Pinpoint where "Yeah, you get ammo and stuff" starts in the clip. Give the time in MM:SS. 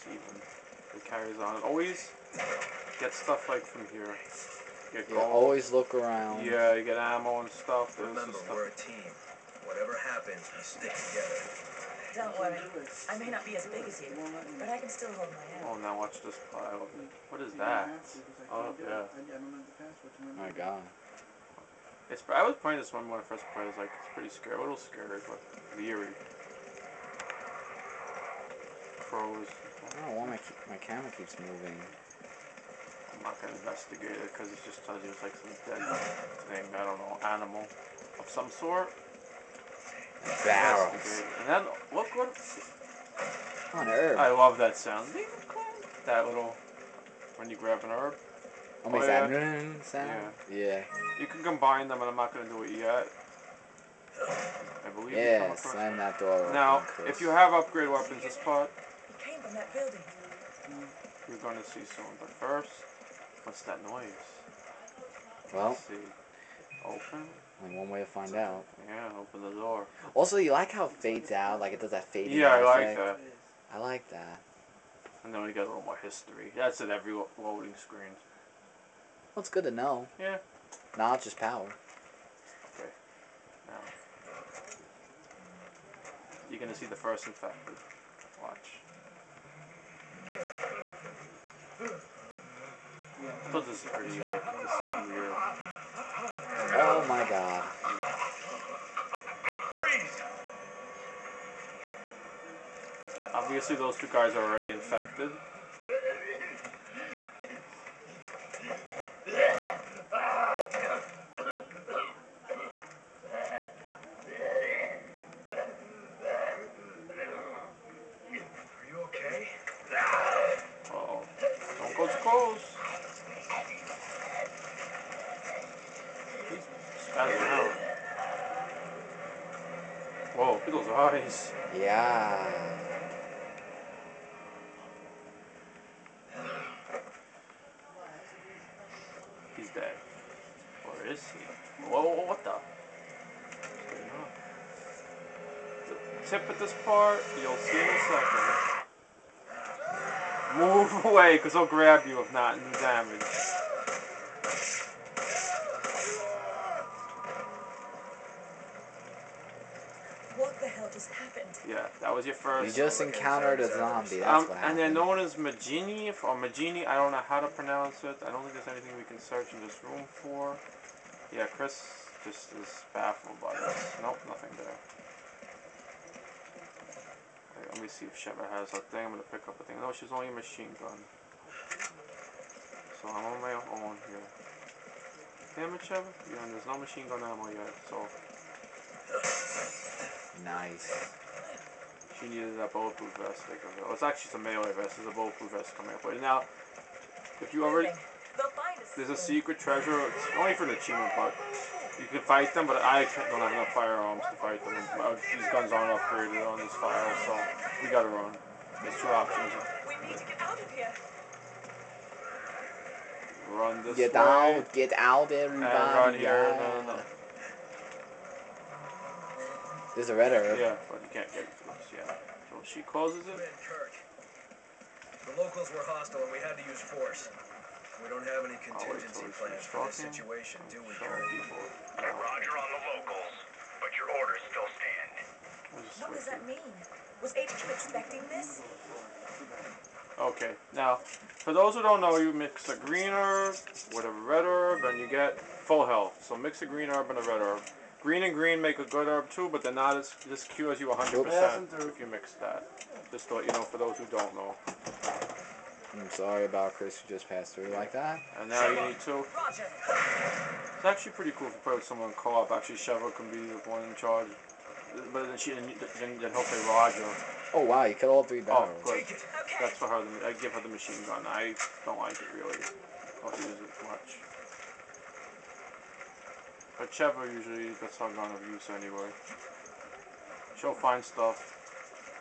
00:06.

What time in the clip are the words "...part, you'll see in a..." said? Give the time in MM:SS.
02:26.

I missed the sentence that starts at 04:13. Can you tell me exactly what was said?
Just to let you know, for those who don't know.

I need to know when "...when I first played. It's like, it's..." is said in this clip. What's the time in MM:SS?
00:23.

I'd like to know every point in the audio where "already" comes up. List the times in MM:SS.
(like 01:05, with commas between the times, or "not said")
01:44, 03:17.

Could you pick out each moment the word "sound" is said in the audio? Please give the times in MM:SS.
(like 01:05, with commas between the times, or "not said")
00:44, 00:49.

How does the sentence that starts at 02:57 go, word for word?
Right, let me see if Sheva has that thing.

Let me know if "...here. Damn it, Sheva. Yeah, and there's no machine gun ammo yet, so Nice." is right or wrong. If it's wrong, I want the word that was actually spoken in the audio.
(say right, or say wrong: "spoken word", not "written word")
right.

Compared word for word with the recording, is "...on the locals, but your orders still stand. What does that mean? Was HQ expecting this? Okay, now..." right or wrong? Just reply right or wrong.
right.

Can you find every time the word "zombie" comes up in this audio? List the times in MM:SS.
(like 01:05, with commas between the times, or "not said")
02:43.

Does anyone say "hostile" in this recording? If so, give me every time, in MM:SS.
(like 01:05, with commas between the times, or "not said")
03:45.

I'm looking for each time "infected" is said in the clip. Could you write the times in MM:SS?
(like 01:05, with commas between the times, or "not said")
01:27, 01:44.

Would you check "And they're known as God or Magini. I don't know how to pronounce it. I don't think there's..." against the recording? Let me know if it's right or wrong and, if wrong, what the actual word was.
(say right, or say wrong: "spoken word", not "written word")
wrong: "Magini", not "God".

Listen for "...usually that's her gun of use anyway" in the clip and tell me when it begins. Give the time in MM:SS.
04:37.